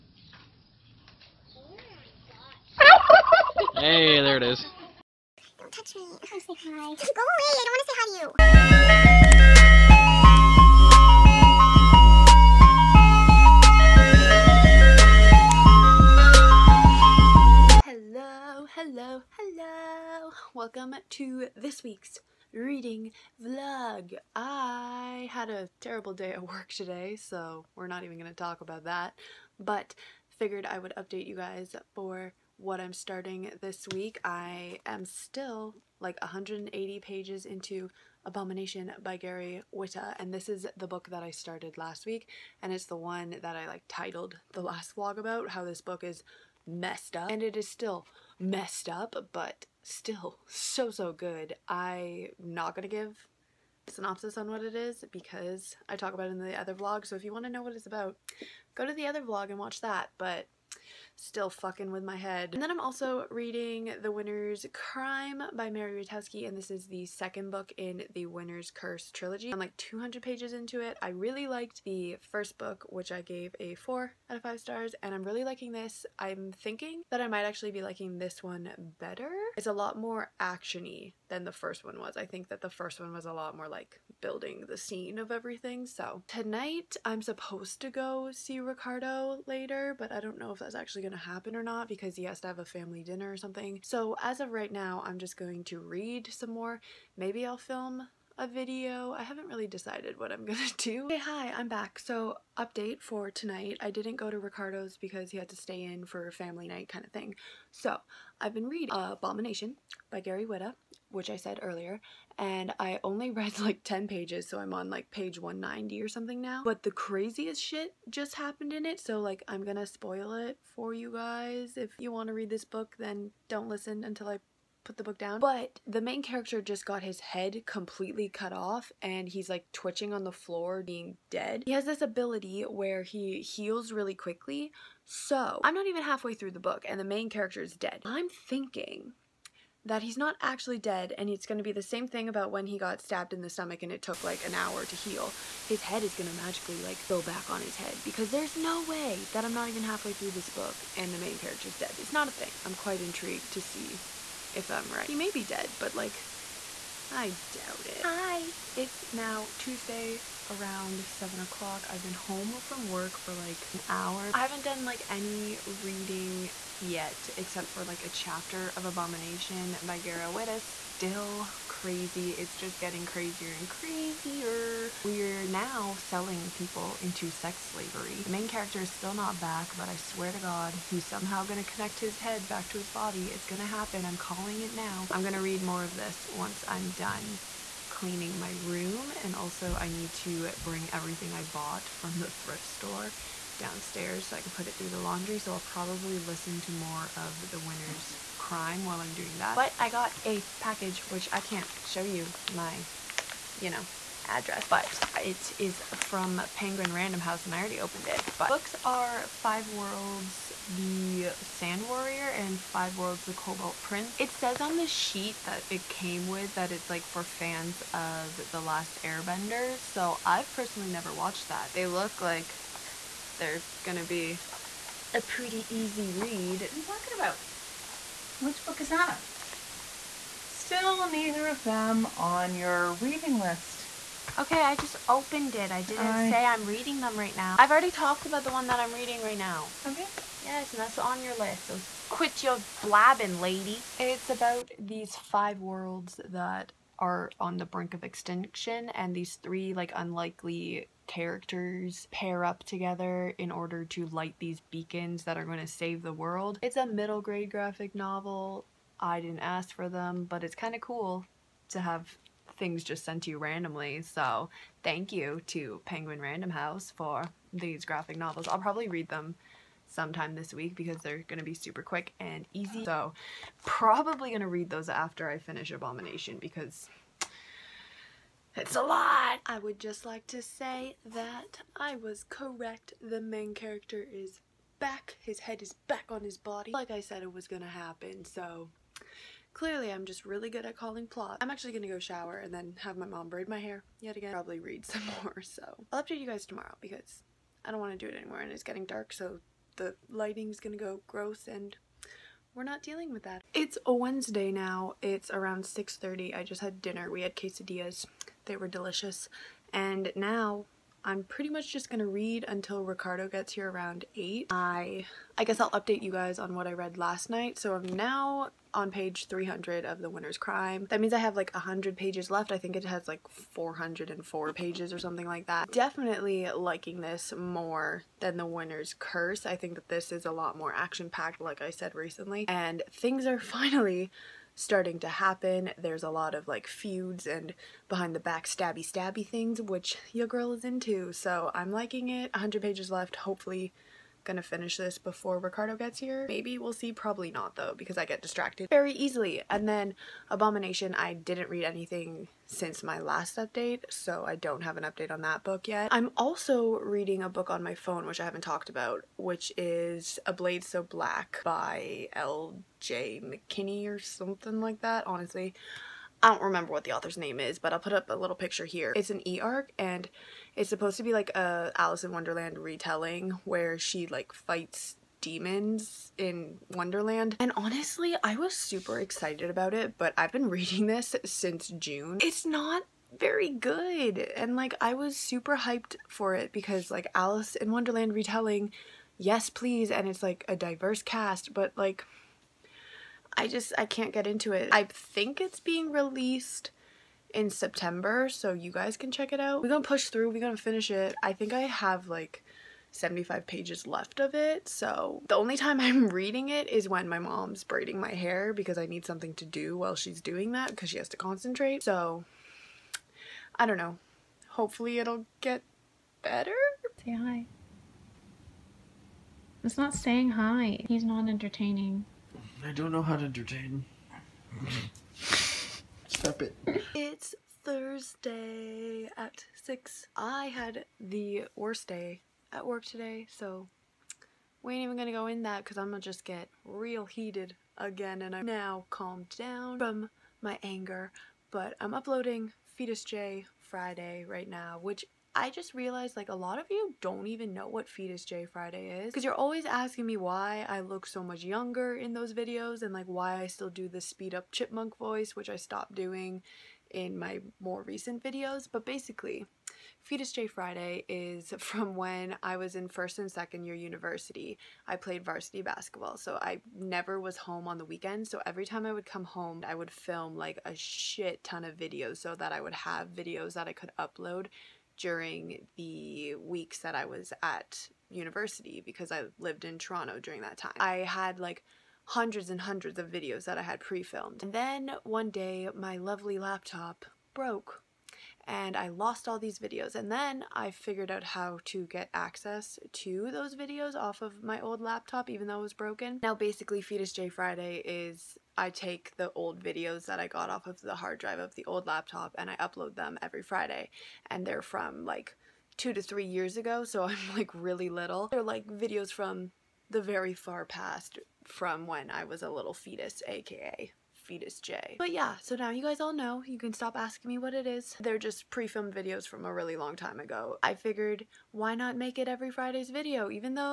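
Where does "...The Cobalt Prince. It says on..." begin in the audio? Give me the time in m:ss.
3:33.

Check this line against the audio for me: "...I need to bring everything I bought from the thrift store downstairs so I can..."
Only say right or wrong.
right.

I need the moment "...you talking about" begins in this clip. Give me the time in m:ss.
3:46.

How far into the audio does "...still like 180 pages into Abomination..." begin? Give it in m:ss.
0:35.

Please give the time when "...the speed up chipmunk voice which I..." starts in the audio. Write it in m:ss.
7:33.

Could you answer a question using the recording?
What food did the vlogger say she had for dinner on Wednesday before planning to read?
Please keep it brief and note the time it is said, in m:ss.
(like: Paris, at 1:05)
Quesadillas, at 5:07.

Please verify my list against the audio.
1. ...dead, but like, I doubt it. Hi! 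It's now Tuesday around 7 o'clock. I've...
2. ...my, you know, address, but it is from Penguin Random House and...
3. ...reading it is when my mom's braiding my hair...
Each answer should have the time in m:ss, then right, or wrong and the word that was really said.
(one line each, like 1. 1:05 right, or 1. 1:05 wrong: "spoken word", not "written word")
1. 2:35 right
2. 3:22 right
3. 6:46 right.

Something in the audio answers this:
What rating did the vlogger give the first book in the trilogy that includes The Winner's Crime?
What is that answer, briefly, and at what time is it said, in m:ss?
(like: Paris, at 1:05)
4 out of 5 stars, at 1:13.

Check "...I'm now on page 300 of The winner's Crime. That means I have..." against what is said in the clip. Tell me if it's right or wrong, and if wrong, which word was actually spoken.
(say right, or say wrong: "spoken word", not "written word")
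right.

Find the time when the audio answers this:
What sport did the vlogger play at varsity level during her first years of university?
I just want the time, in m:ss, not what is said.
7:45.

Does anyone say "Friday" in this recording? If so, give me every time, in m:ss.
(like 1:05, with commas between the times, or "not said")
7:23, 7:28, 7:40, 8:17, 8:23, 8:42.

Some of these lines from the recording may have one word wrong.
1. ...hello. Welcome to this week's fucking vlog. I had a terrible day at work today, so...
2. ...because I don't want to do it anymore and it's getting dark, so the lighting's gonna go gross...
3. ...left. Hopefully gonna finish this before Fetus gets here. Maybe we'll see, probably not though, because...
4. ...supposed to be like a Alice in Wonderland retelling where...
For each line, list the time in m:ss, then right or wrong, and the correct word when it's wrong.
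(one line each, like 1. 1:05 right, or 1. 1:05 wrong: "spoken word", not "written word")
1. 0:19 wrong: "reading", not "fucking"
2. 4:56 right
3. 5:42 wrong: "Ricardo", not "Fetus"
4. 6:10 right.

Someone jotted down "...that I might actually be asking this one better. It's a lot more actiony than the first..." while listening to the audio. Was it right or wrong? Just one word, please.
wrong.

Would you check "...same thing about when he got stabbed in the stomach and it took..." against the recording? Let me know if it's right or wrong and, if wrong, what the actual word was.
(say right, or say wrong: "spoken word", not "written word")
right.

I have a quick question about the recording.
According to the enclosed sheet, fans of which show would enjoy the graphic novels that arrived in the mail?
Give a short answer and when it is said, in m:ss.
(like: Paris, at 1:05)
The Last Airbender, at 3:38.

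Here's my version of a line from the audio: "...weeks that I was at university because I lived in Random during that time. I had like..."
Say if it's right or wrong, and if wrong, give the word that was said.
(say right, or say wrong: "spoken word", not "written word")
wrong: "Toronto", not "Random".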